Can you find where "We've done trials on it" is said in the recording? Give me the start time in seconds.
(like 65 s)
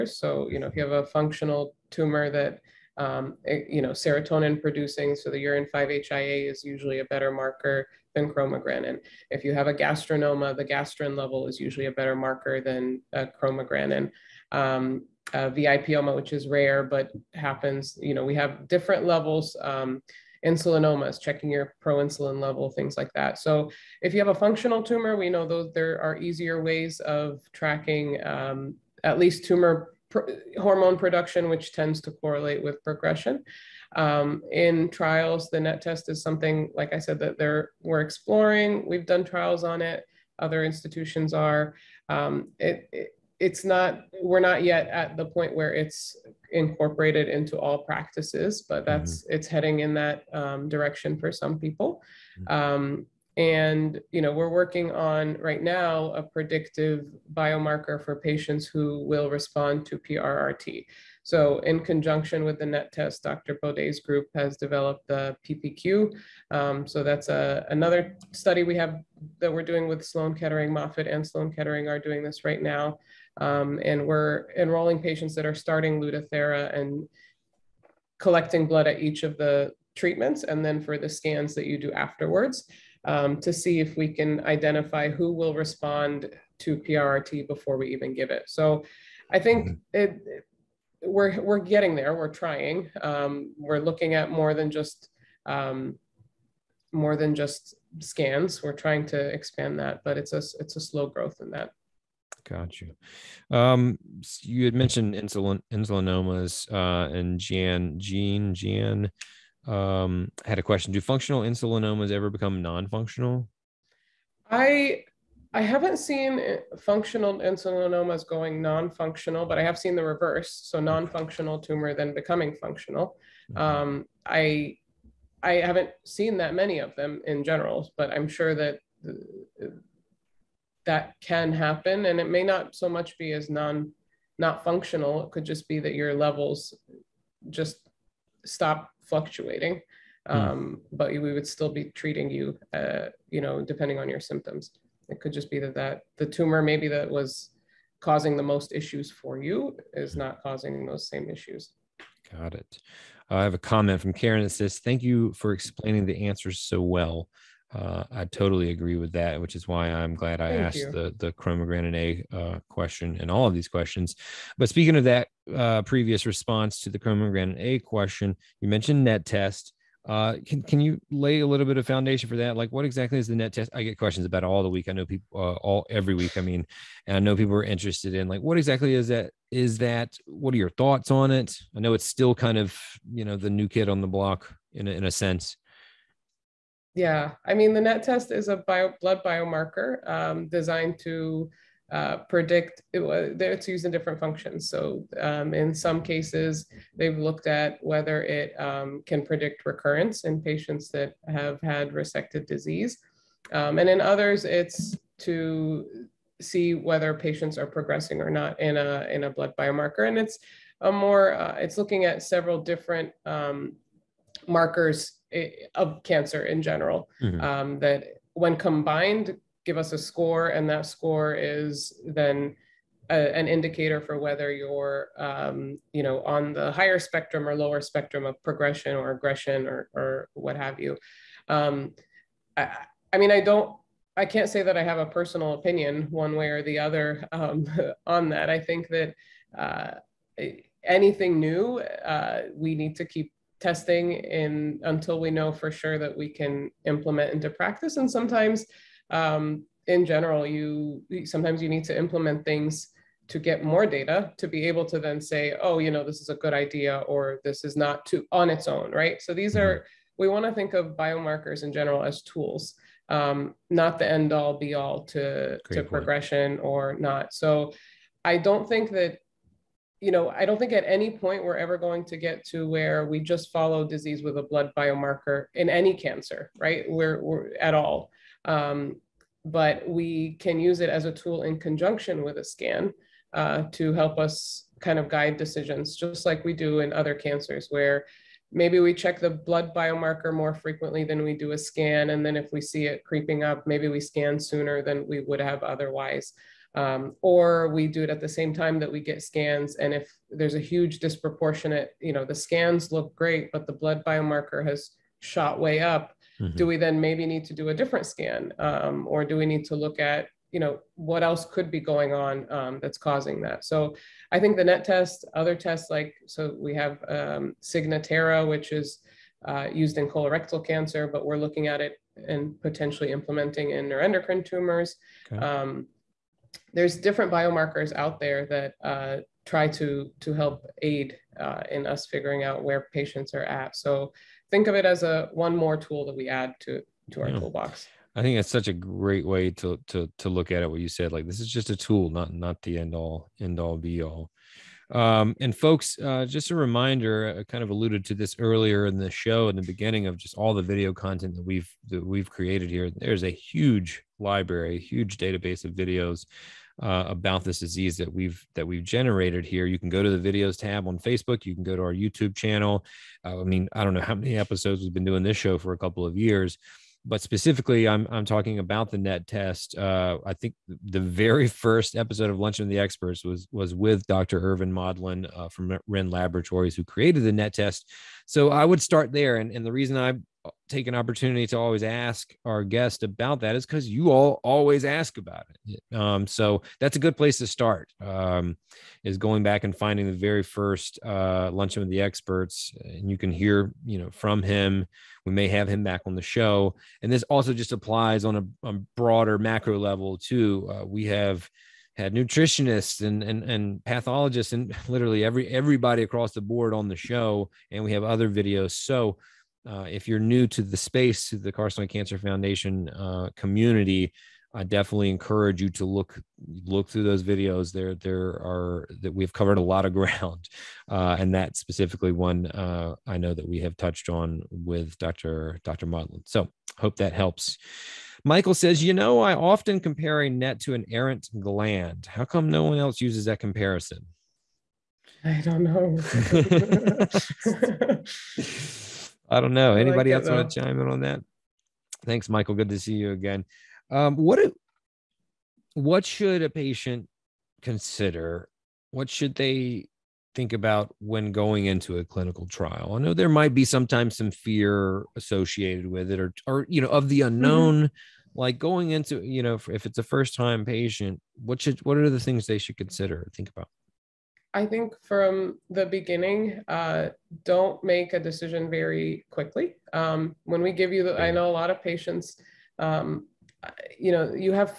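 38 s.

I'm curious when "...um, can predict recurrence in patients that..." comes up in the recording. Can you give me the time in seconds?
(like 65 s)
198 s.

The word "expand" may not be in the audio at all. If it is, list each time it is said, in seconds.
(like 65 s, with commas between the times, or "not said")
99 s.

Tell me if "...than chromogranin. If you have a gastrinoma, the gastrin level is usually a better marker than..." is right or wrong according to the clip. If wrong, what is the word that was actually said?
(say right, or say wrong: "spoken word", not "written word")
right.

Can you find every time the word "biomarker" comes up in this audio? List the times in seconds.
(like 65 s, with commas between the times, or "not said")
57 s, 189 s, 209 s, 260 s, 274 s, 289 s, 304 s, 327 s.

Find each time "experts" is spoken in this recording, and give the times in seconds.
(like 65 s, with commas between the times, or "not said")
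372 s, 392 s.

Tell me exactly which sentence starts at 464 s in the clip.
I think from the beginning, uh, don't make a decision very quickly.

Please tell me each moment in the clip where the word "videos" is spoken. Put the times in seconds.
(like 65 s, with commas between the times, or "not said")
350 s, 355 s, 360 s, 408 s, 417 s.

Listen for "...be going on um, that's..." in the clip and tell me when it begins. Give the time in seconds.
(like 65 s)
311 s.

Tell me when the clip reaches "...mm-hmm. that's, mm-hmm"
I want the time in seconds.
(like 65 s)
48 s.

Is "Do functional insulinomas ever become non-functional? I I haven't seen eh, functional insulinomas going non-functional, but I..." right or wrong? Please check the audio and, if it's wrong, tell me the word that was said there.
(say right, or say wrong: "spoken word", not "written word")
right.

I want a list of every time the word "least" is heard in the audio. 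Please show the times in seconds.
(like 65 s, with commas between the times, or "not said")
29 s.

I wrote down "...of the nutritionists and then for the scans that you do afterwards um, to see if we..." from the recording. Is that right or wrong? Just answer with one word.
wrong.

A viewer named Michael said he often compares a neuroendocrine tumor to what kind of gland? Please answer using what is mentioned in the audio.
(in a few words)
errant gland.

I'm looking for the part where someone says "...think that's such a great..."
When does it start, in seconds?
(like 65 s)
338 s.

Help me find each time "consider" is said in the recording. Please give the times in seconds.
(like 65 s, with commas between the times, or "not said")
447 s, 462 s.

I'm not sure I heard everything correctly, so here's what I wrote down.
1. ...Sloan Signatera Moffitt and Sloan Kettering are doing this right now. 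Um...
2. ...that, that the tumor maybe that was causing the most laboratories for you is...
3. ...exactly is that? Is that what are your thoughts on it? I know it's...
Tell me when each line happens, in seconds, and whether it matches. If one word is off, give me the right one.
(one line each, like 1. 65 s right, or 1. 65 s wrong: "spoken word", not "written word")
1. 70 s wrong: "Kettering", not "Signatera"
2. 145 s wrong: "issues", not "laboratories"
3. 178 s right.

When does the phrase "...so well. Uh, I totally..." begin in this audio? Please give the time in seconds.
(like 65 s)
156 s.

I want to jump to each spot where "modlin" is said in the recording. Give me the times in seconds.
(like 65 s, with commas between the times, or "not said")
374 s, 425 s.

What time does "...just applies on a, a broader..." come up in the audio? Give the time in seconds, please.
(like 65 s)
397 s.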